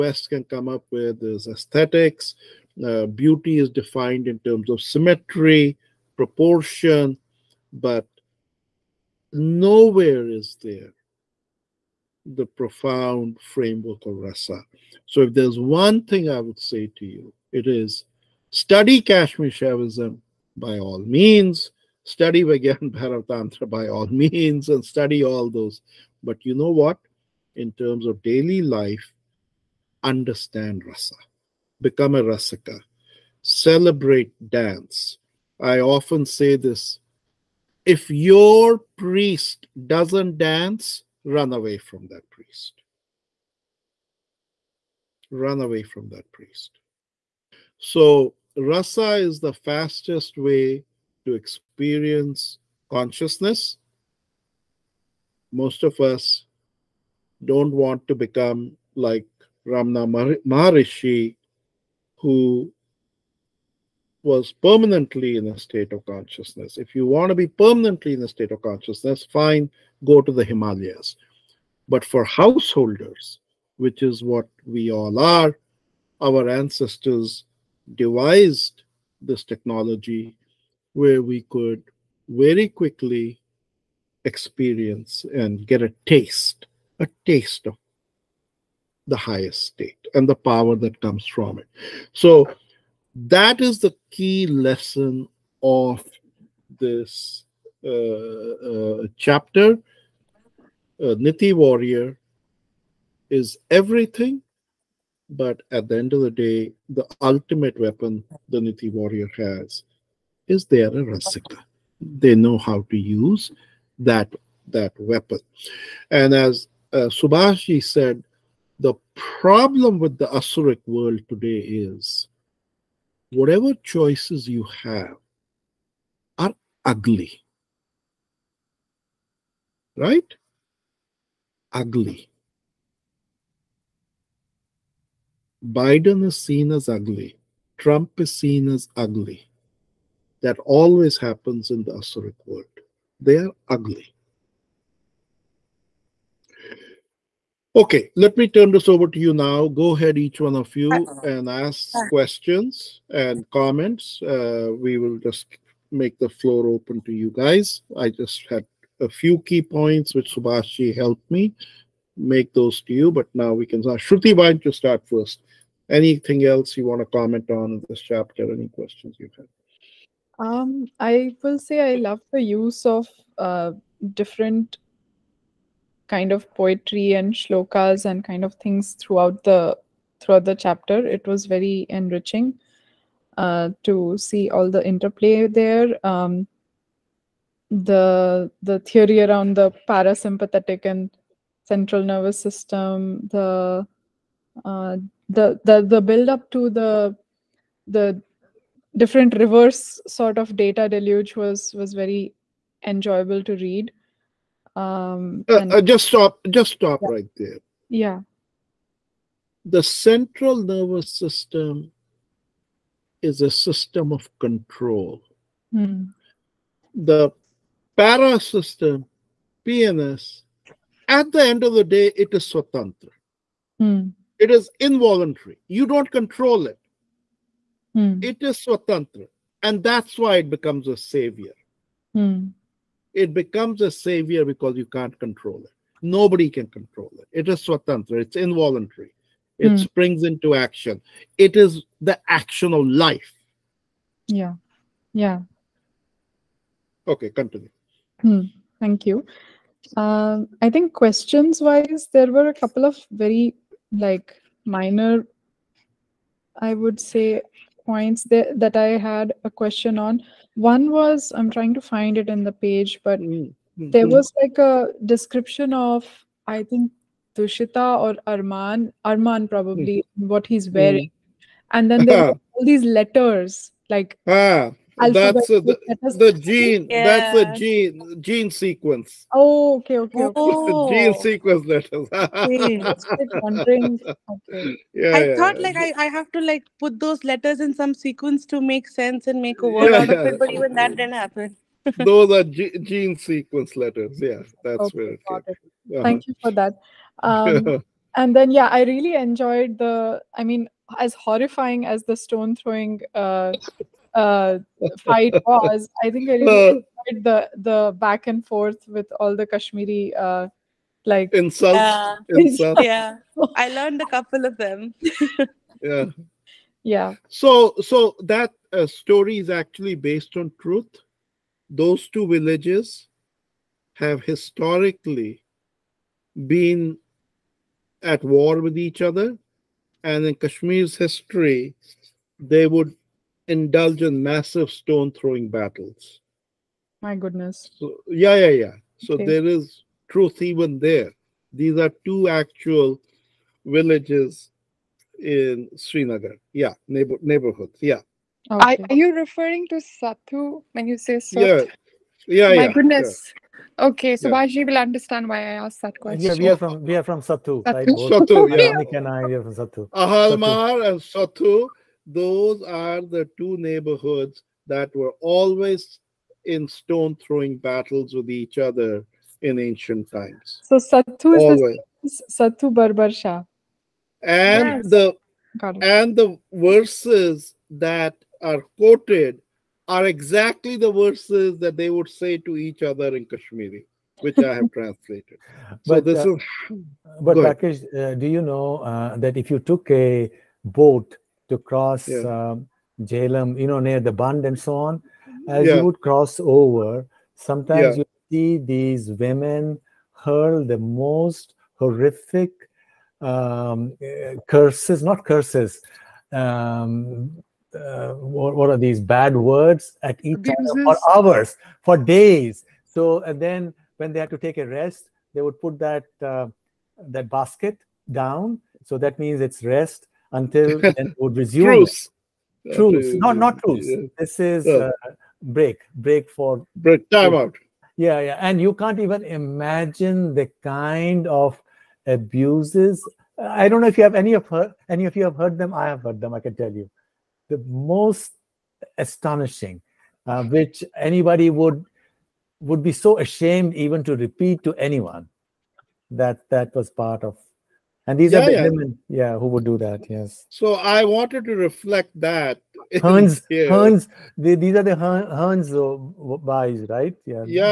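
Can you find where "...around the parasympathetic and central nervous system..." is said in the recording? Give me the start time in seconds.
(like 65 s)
189 s.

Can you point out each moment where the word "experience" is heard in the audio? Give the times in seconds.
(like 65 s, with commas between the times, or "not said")
51 s, 84 s.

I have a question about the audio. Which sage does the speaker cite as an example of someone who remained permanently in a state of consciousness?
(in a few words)
Ramana Maharishi.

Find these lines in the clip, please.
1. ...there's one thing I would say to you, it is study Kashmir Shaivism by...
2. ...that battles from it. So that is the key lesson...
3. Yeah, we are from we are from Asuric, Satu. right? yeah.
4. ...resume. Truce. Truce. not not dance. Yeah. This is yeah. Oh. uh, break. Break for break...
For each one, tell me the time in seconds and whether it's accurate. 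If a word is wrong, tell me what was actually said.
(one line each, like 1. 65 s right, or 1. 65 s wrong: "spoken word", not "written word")
1. 15 s right
2. 90 s wrong: "comes", not "battles"
3. 356 s wrong: "Satu", not "Asuric"
4. 421 s wrong: "truce", not "dance".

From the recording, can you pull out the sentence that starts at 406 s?
Um, uh, what, what, are these bad words at each other for hours, for days?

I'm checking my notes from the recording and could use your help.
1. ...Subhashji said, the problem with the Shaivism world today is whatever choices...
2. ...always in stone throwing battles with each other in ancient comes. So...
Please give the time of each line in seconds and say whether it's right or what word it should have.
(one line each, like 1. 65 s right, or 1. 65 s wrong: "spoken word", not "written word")
1. 117 s wrong: "Asuric", not "Shaivism"
2. 365 s wrong: "times", not "comes".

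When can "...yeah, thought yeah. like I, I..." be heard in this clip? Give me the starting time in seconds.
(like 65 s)
285 s.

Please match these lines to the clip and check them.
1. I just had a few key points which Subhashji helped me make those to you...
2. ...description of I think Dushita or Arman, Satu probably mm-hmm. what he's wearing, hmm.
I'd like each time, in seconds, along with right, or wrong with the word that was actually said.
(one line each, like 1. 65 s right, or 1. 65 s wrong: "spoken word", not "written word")
1. 157 s right
2. 265 s wrong: "Arman", not "Satu".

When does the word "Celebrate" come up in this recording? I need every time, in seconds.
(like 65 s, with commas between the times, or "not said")
33 s.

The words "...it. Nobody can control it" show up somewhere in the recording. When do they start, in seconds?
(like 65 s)
235 s.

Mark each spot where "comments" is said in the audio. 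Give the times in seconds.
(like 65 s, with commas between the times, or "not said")
153 s, 167 s.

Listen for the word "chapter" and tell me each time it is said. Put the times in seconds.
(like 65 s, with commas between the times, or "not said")
99 s, 168 s, 180 s.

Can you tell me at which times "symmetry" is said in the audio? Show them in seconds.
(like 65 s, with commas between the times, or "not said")
4 s.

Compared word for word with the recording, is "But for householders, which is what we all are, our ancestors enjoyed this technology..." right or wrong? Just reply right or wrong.
wrong.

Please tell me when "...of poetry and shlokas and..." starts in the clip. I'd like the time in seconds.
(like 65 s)
176 s.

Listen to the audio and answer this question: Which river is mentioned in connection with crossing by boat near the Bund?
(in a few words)
Jhelum.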